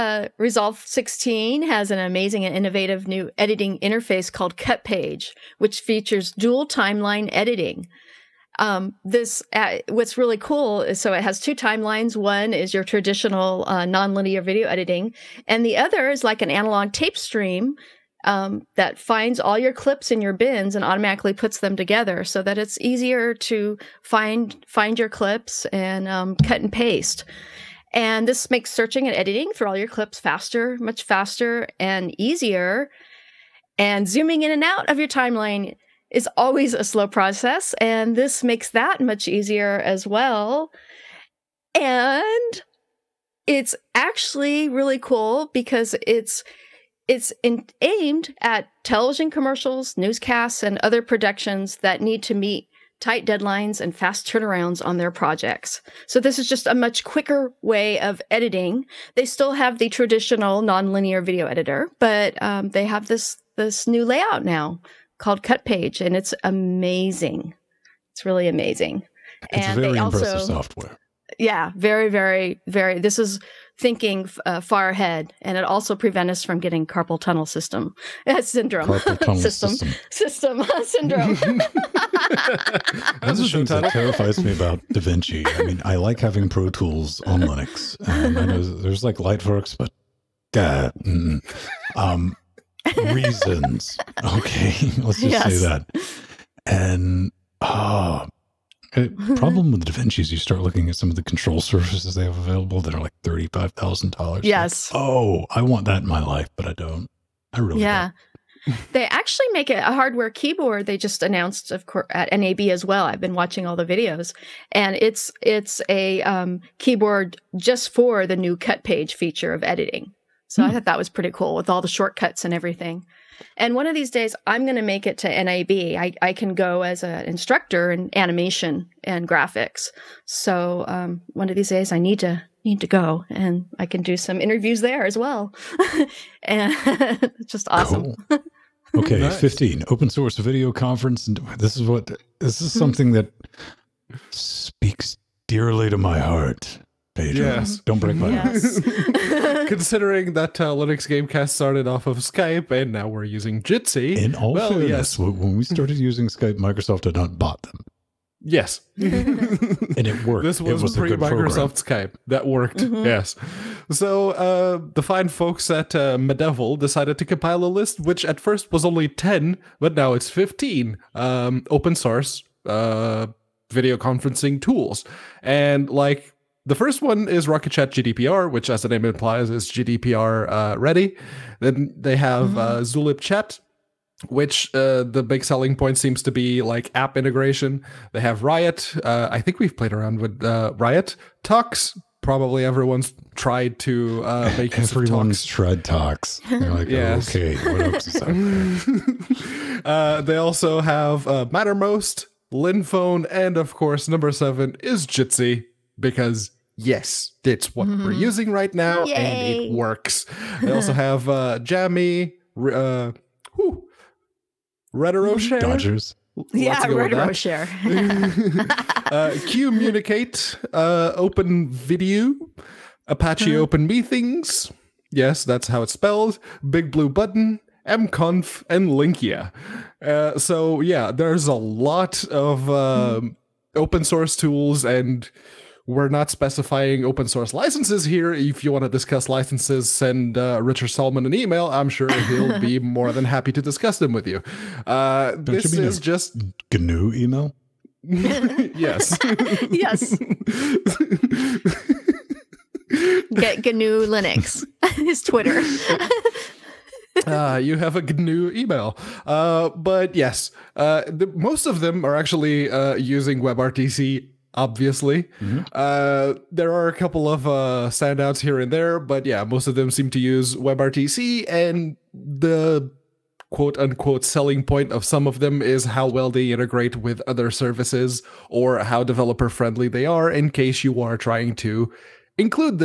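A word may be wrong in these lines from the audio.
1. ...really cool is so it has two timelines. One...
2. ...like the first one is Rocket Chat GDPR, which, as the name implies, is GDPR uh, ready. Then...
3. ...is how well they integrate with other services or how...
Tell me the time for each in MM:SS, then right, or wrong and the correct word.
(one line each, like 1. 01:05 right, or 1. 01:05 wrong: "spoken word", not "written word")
1. 00:10 right
2. 02:55 right
3. 04:35 right.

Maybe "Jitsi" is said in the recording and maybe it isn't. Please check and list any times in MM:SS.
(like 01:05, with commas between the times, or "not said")
02:33, 03:25.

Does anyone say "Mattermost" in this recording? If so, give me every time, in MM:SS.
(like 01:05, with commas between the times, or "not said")
03:21.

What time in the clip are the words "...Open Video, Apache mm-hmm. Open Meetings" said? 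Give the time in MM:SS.
03:41.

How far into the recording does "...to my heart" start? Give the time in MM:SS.
02:25.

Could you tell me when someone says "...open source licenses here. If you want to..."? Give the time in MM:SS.
03:57.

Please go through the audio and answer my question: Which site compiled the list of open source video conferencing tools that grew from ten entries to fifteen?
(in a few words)
Medevel.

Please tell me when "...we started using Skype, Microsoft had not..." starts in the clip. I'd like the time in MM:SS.
02:35.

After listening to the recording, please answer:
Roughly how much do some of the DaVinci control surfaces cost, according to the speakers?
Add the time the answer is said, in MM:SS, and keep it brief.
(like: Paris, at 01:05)
$35,000, at 01:43.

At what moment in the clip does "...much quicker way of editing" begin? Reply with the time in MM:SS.
00:56.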